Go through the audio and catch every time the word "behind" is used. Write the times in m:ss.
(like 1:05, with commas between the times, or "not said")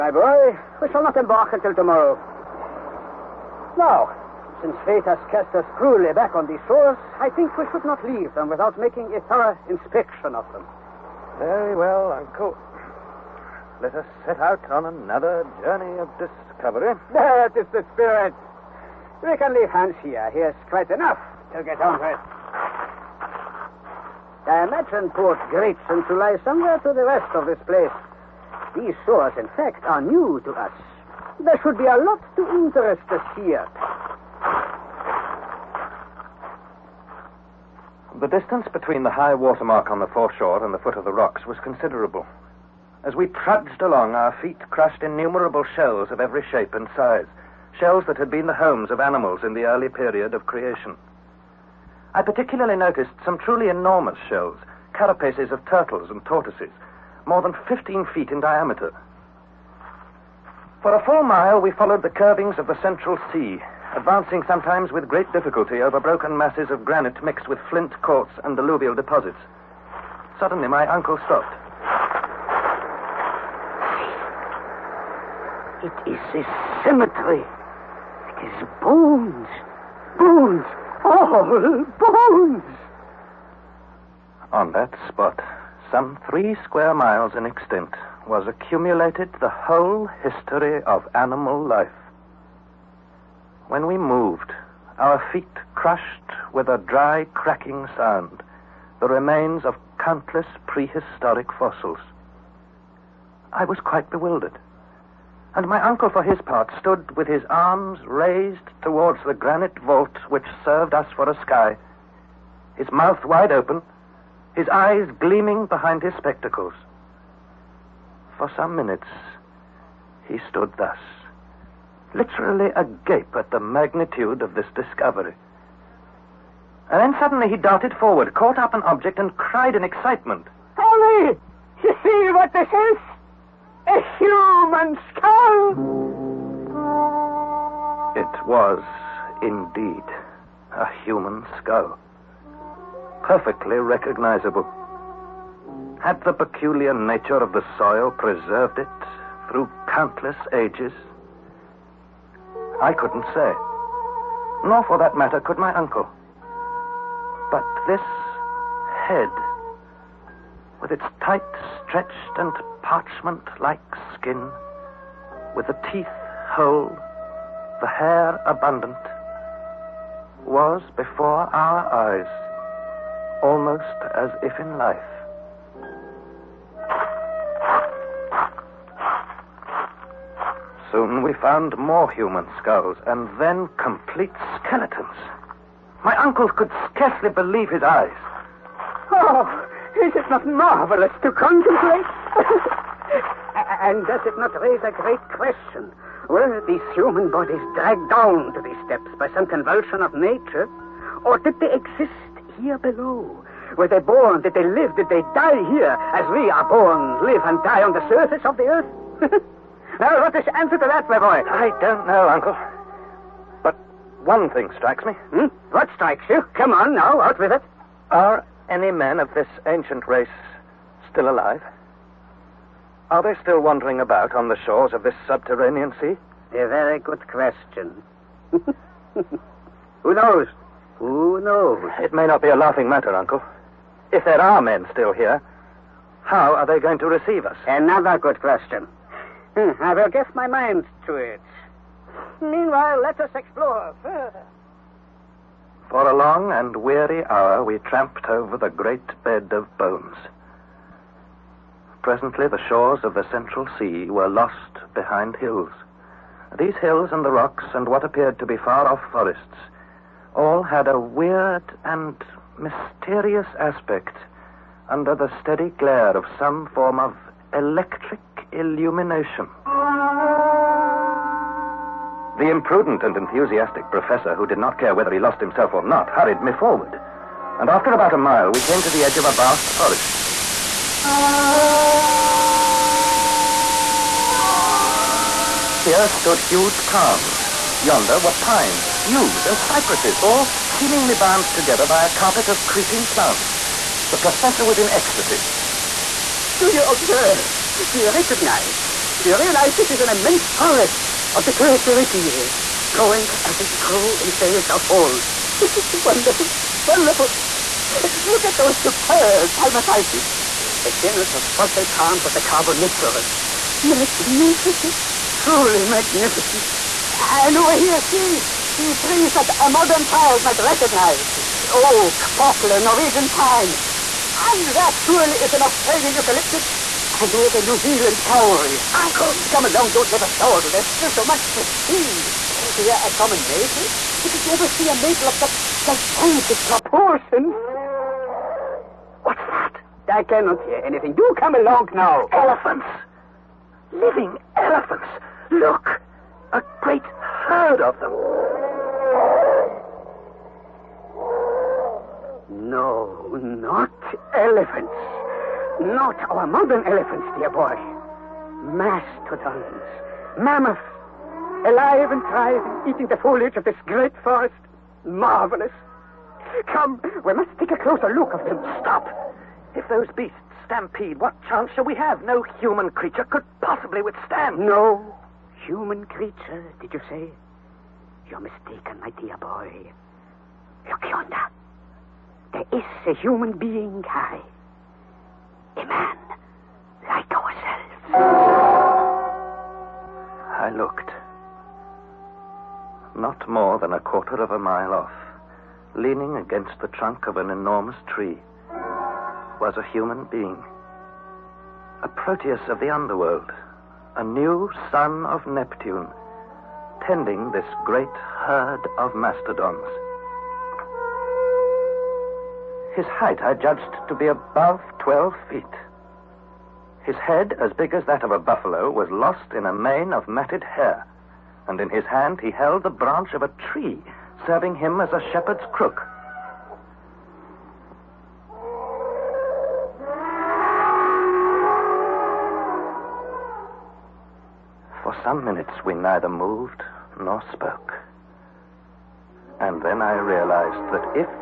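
1:55, 4:14.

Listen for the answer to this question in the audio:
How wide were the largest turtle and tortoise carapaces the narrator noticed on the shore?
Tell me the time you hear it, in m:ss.
0:57.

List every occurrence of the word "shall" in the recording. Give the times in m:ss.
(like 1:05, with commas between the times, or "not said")
0:00, 6:11.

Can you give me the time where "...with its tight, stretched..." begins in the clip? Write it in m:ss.
2:40.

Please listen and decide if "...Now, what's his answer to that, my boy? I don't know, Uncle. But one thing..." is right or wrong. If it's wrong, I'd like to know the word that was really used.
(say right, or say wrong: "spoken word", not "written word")
right.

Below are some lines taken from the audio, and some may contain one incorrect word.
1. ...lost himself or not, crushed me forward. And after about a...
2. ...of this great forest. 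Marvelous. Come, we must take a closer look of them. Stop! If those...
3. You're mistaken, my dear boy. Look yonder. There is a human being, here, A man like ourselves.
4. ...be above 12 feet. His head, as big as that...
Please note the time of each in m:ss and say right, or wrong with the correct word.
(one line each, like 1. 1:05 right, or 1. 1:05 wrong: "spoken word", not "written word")
1. 4:35 wrong: "hurried", not "crushed"
2. 6:03 right
3. 6:18 right
4. 6:54 right.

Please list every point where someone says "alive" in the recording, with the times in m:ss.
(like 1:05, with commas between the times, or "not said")
3:41, 6:01.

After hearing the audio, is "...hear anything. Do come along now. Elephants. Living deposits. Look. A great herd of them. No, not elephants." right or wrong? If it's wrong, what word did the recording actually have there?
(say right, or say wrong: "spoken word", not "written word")
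wrong: "elephants", not "deposits".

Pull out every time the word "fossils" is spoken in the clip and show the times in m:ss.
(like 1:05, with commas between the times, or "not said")
1:41, 5:11.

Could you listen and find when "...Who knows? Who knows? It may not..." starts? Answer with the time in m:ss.
3:50.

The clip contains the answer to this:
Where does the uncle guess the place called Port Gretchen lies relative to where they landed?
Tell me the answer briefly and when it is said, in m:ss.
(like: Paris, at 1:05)
To the west, at 0:26.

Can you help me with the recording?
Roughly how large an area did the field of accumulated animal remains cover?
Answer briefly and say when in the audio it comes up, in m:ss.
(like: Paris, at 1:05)
3 square miles, at 1:26.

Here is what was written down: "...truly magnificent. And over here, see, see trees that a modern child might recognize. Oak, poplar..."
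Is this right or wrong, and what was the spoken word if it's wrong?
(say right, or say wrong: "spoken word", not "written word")
right.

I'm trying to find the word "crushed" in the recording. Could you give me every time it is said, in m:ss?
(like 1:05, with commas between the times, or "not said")
0:44, 1:35.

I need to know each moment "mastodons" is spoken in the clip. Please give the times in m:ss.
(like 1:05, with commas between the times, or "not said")
5:58, 6:49.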